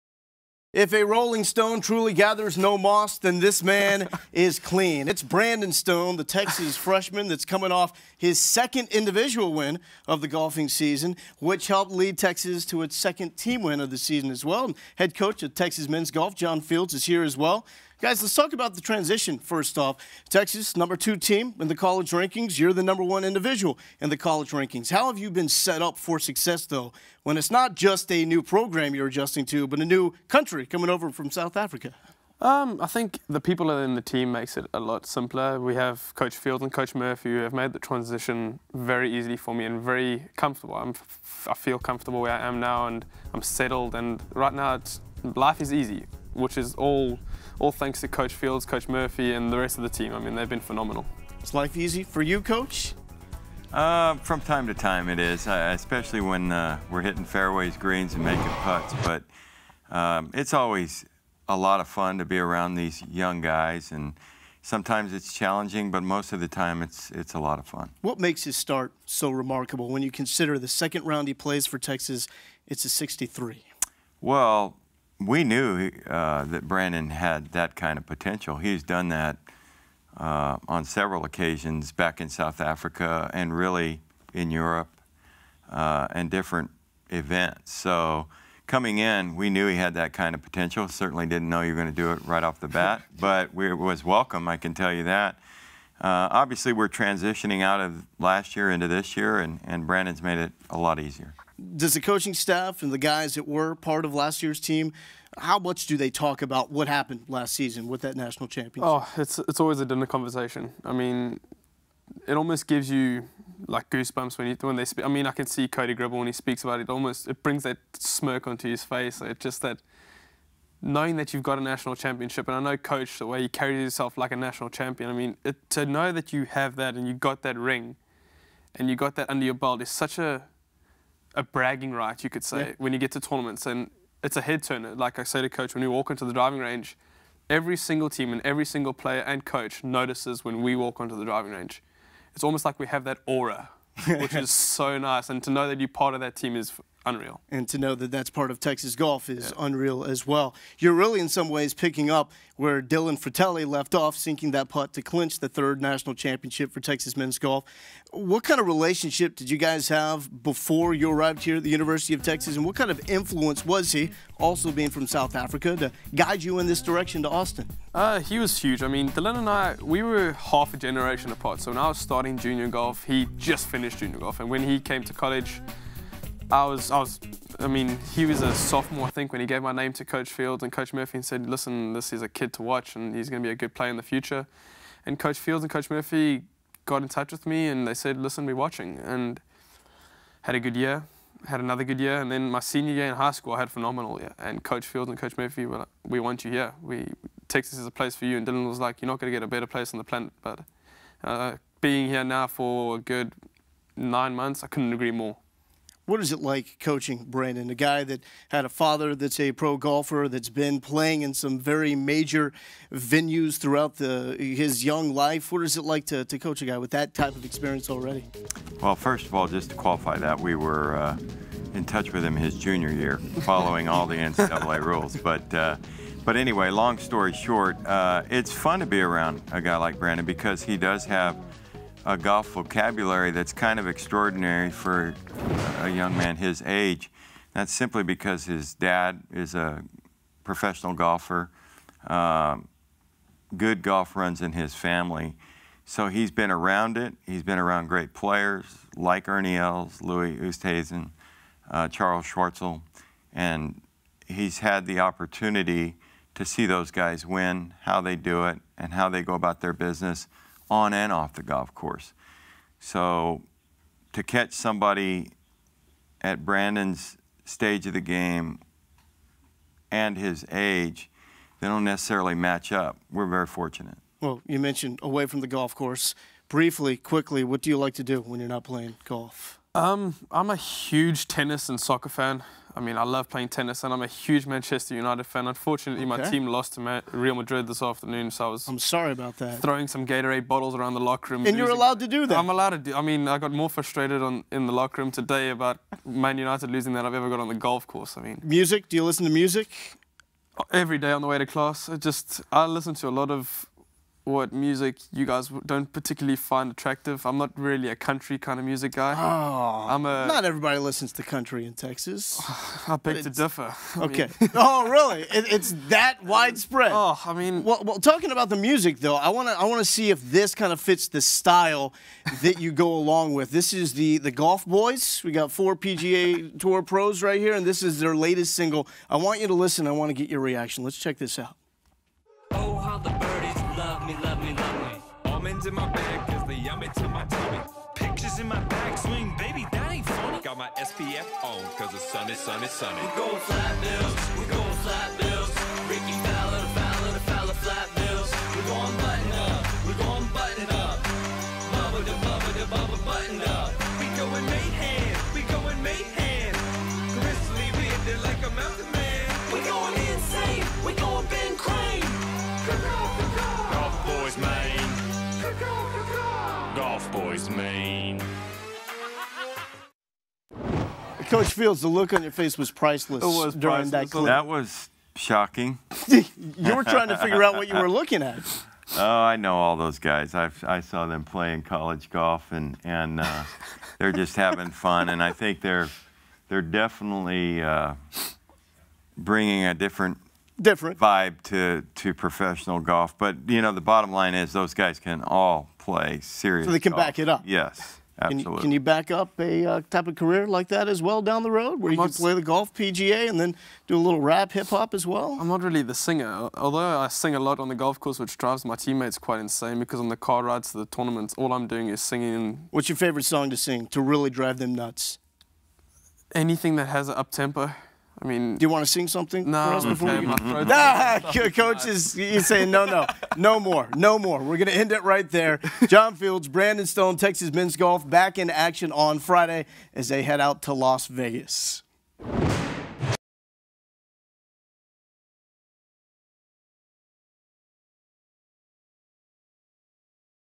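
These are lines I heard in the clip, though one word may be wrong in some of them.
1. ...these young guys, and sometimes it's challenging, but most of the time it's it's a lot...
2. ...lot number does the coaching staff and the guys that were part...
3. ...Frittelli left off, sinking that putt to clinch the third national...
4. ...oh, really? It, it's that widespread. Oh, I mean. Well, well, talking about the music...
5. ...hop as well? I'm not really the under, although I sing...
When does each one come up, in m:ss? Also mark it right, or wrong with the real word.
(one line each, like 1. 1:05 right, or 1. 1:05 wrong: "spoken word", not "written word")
1. 1:02 right
2. 1:40 wrong: "easier", not "number"
3. 2:33 right
4. 5:14 right
5. 6:44 wrong: "singer", not "under".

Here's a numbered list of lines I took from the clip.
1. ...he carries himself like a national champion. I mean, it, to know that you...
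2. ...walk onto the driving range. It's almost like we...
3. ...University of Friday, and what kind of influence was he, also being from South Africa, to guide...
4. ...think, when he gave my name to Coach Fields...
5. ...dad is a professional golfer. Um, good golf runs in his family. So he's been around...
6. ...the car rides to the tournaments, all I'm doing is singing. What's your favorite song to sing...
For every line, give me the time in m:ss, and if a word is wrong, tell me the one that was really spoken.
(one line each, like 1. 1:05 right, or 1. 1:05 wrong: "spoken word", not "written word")
1. 2:03 right
2. 2:20 right
3. 2:41 wrong: "Texas", not "Friday"
4. 2:59 right
5. 3:58 right
6. 6:50 right.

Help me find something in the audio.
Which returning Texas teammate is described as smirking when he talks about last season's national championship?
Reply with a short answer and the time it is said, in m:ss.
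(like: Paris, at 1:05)
Cody Gribble, at 1:55.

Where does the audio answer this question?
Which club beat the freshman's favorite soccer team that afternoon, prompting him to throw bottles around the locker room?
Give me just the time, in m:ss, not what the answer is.
4:47.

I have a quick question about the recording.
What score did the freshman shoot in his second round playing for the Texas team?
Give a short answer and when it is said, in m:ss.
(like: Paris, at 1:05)
63, at 1:12.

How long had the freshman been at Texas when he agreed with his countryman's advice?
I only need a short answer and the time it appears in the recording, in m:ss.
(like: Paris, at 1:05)
9 months, at 3:23.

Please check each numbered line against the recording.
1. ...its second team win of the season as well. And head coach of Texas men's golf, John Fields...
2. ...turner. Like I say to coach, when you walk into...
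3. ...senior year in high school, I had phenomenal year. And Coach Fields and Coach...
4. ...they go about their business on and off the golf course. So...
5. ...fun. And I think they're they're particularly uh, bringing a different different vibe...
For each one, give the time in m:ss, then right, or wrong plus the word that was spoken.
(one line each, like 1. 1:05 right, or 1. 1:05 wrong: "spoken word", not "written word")
1. 0:12 right
2. 2:14 right
3. 3:12 right
4. 4:19 right
5. 6:24 wrong: "definitely", not "particularly".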